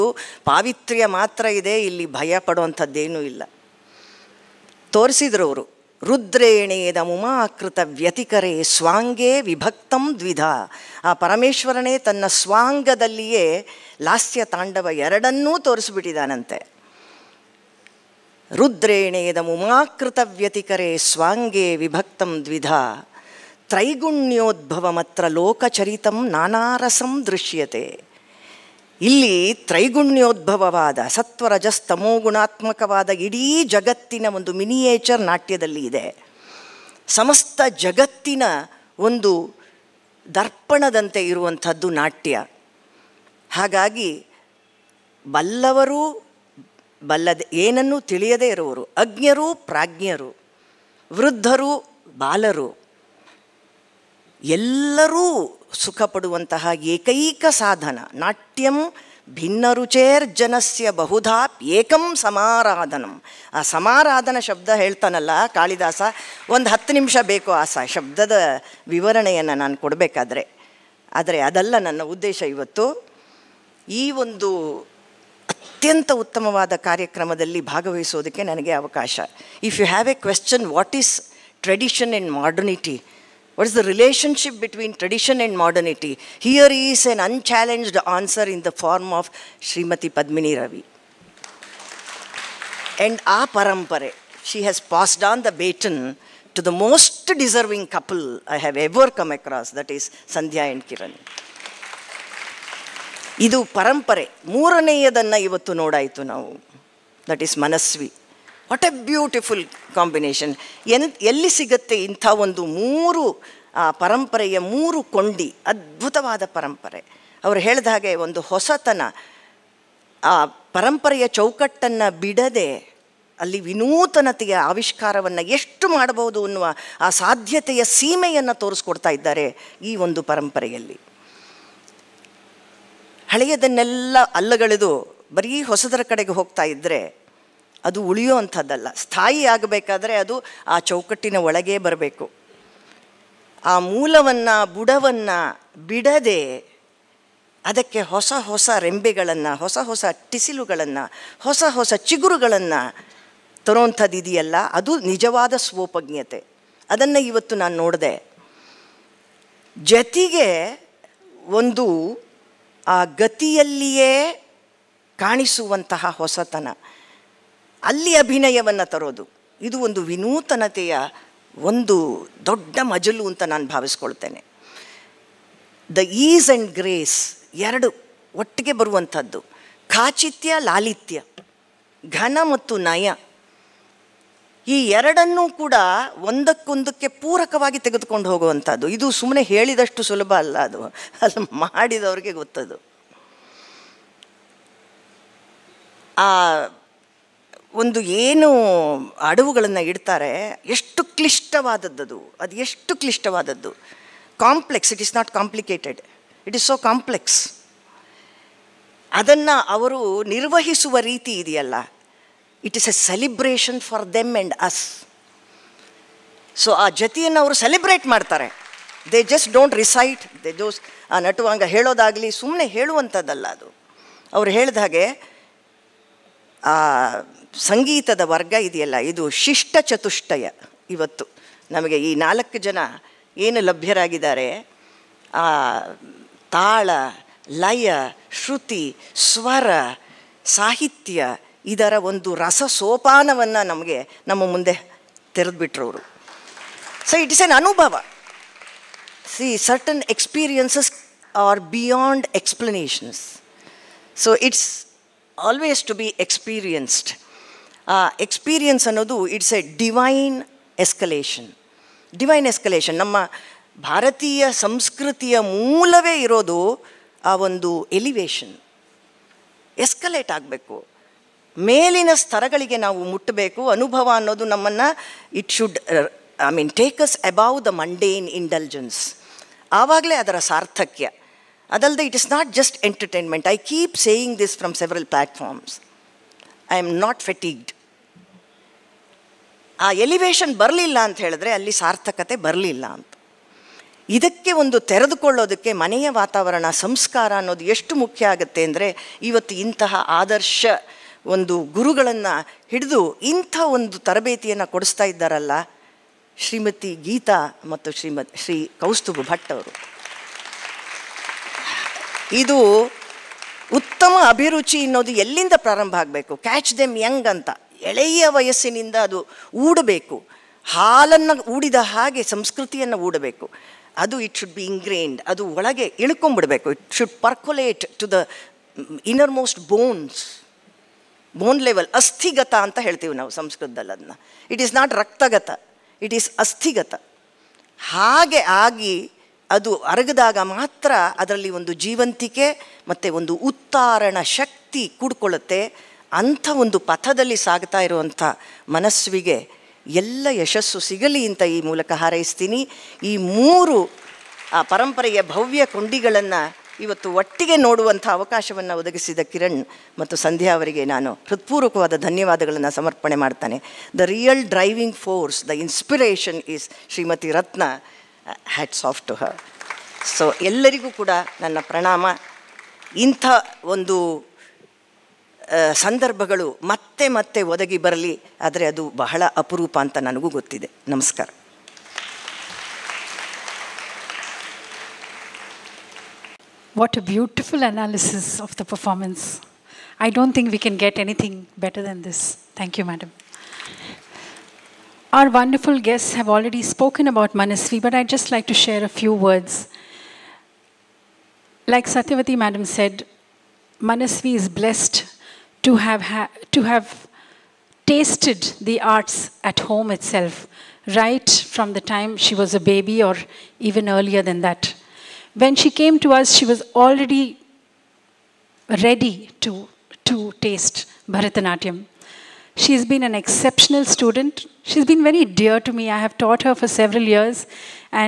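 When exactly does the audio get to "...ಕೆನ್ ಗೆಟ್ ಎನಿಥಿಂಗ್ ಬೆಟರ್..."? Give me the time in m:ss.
6:30.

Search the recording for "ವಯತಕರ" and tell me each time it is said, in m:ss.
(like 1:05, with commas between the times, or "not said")
0:07, 0:20.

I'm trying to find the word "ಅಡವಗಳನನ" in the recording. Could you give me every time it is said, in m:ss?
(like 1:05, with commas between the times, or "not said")
3:19.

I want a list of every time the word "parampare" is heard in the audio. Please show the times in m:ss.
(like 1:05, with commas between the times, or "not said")
1:33, 1:43.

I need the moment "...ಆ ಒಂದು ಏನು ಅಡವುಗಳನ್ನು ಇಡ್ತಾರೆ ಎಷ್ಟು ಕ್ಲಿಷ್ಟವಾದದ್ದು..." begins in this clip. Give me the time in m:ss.
3:16.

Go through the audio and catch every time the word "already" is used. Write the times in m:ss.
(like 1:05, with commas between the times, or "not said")
6:36, 6:56.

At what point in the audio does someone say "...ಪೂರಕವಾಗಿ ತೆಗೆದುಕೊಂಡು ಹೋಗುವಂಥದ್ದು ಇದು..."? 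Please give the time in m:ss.
3:07.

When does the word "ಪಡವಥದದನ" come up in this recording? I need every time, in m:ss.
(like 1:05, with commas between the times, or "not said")
0:02.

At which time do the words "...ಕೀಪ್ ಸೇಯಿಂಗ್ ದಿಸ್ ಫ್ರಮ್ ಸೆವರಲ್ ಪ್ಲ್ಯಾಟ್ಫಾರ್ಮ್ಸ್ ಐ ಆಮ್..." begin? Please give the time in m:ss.
4:43.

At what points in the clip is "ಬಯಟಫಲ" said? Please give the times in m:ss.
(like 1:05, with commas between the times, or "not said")
1:49, 6:27.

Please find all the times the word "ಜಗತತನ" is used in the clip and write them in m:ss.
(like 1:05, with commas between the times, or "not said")
0:33, 0:37.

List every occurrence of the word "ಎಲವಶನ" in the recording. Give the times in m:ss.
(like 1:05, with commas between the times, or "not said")
4:27, 4:50.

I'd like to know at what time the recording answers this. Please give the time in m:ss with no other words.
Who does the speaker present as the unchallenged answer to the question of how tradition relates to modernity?
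1:29.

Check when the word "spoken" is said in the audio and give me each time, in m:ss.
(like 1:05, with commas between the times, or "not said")
6:36.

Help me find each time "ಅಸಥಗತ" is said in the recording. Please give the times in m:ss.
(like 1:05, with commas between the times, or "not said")
5:32, 5:36.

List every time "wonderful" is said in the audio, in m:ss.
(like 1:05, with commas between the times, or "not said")
6:35.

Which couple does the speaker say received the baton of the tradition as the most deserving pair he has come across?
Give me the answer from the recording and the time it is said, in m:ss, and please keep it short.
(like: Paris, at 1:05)
Sandhya and Kiran, at 1:40.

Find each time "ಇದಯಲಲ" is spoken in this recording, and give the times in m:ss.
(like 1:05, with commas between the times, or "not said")
2:34, 3:31, 3:48.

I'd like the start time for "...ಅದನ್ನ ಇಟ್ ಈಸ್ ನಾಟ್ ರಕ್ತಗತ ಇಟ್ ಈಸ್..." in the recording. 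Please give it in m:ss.
5:33.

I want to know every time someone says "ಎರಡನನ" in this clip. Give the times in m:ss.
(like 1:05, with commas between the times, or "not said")
0:15, 3:04.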